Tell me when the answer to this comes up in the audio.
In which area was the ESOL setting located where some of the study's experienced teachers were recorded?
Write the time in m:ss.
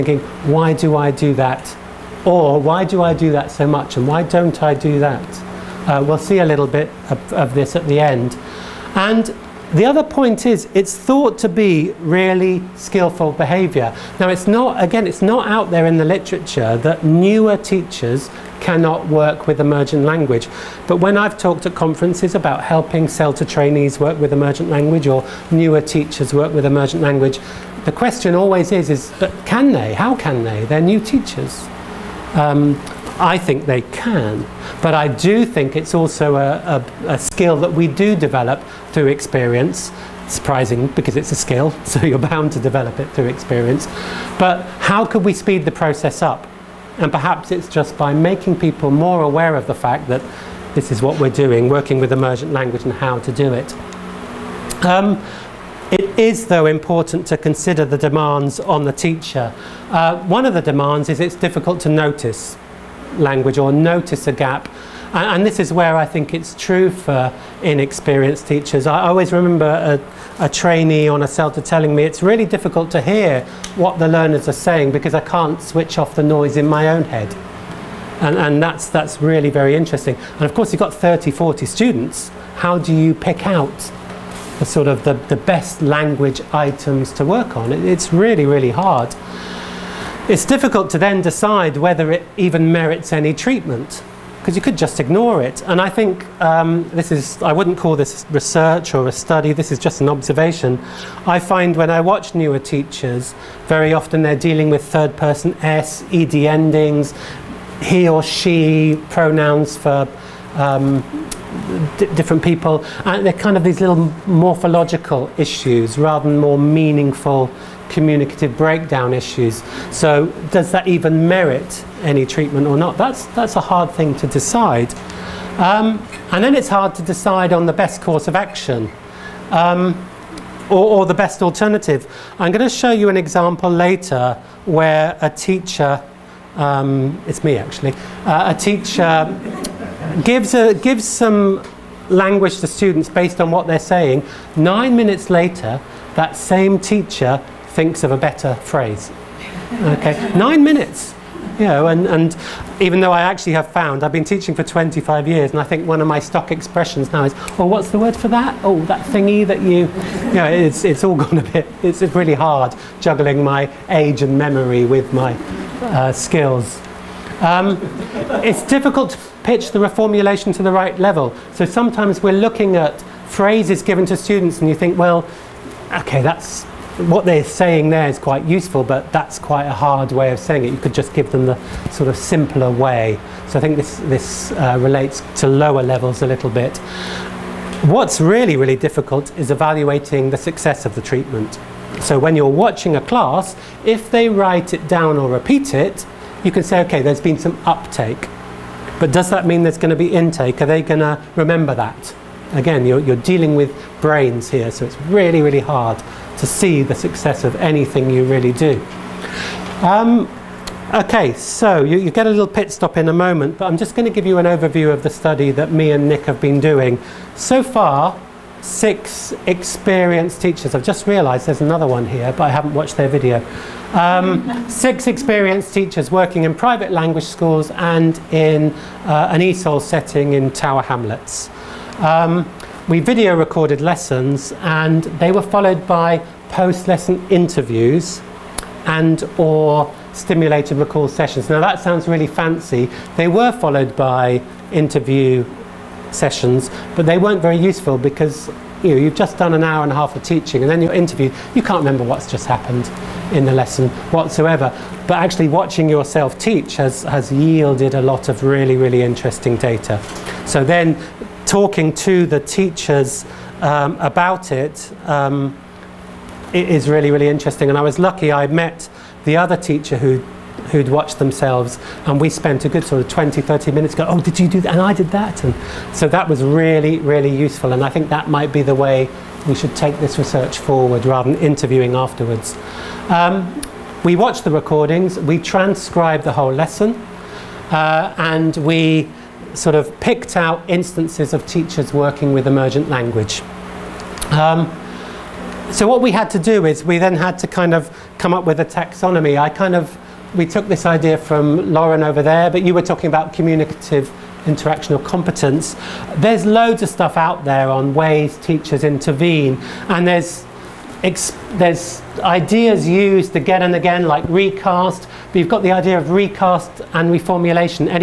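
3:50.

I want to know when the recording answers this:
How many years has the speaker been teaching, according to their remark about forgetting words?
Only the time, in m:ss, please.
2:34.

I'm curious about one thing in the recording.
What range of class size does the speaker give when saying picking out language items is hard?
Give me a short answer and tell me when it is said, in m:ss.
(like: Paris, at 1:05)
30, 40, at 1:20.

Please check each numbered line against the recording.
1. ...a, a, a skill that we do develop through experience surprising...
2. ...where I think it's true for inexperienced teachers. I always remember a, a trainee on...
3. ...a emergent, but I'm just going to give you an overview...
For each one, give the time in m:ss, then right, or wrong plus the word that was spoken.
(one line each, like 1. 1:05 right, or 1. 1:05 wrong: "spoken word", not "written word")
1. 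0:36 right
2. 1:05 right
3. 3:33 wrong: "moment", not "emergent".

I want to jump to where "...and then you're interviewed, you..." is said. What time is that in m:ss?
4:10.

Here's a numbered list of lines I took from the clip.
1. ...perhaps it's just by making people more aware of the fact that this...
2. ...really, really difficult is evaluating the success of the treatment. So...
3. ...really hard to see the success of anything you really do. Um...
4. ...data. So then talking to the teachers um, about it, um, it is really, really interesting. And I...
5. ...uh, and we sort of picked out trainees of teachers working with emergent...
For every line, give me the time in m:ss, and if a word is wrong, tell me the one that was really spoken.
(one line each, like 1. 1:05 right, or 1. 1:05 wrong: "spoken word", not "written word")
1. 0:47 right
2. 3:08 right
3. 3:25 right
4. 4:19 right
5. 4:47 wrong: "instances", not "trainees".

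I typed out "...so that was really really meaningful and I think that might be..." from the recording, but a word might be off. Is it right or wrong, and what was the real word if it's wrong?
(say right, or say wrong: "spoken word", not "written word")
wrong: "useful", not "meaningful".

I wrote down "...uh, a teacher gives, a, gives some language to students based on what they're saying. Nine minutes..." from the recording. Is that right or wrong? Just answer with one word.
right.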